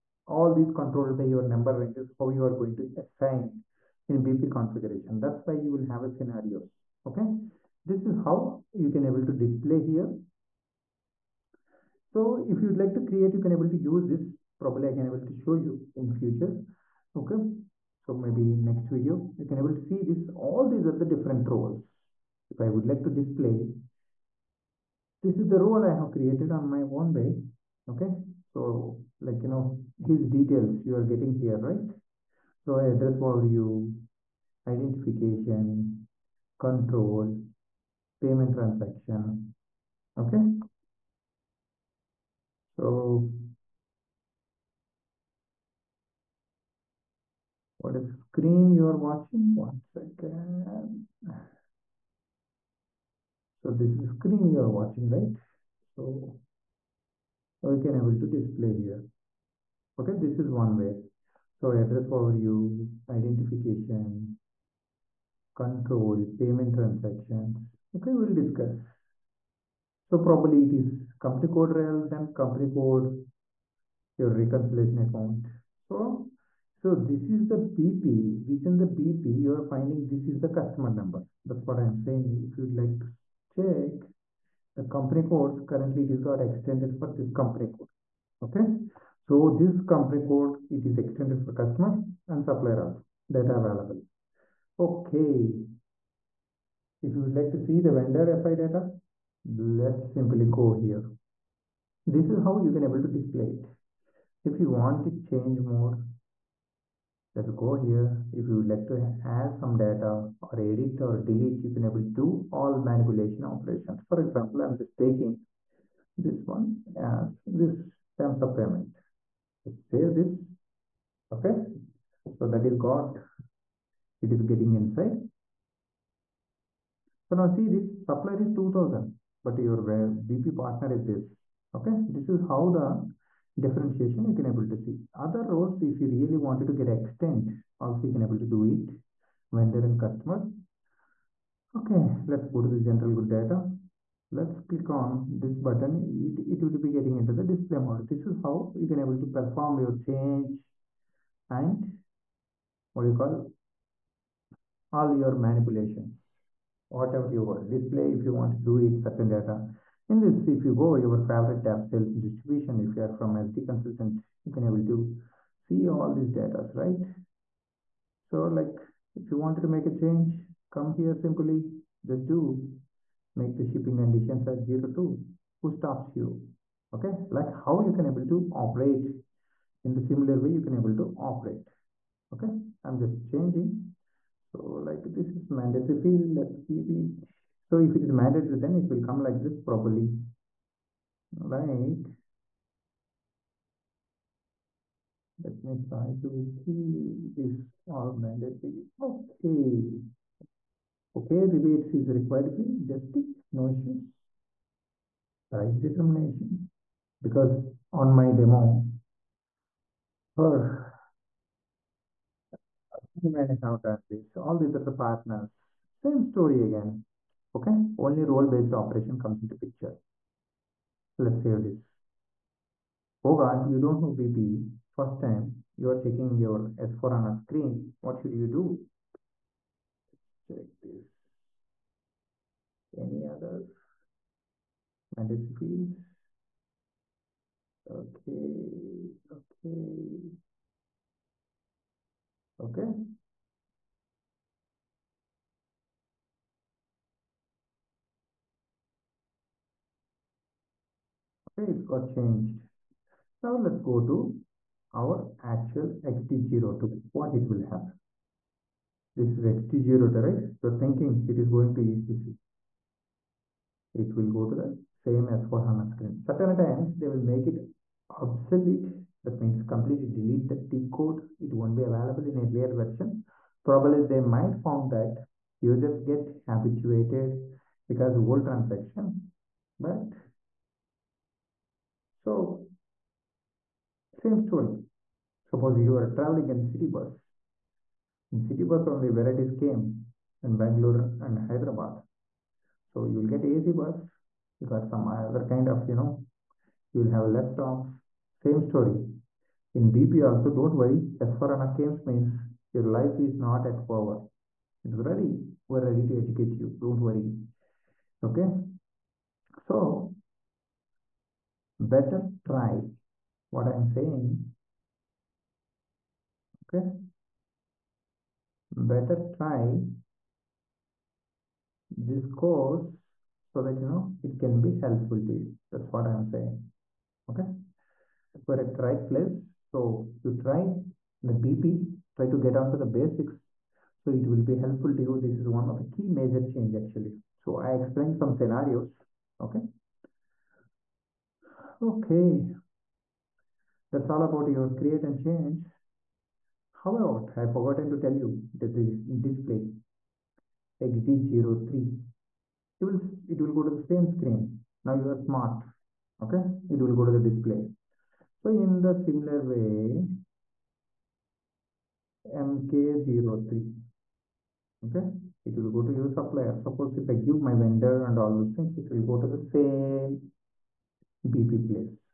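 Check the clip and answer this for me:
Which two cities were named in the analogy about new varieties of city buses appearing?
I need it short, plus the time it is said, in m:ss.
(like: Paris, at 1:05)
Bangalore and Hyderabad, at 4:50.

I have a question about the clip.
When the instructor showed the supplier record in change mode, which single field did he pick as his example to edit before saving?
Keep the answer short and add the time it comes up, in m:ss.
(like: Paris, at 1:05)
Terms of payment, at 1:58.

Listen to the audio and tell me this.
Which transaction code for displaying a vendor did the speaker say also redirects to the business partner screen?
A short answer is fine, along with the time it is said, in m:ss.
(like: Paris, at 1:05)
MK03, at 6:02.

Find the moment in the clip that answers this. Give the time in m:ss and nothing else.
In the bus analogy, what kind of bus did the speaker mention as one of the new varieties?
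4:53.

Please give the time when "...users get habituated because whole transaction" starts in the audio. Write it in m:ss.
4:35.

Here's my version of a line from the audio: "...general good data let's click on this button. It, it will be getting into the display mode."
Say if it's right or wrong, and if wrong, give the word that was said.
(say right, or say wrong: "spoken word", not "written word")
right.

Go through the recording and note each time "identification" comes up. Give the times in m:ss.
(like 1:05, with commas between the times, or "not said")
0:34, 1:03.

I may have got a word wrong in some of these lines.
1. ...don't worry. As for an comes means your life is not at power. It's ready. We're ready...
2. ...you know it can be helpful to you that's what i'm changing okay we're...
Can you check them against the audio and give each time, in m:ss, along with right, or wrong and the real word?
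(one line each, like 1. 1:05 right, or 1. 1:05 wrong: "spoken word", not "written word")
1. 5:00 right
2. 5:23 wrong: "saying", not "changing".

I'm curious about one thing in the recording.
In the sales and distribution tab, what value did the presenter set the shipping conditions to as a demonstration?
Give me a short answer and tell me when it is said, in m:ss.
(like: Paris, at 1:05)
02, at 2:54.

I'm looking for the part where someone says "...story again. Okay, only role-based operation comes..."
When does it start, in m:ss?
3:36.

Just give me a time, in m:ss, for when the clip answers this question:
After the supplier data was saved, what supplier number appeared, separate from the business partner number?
2:08.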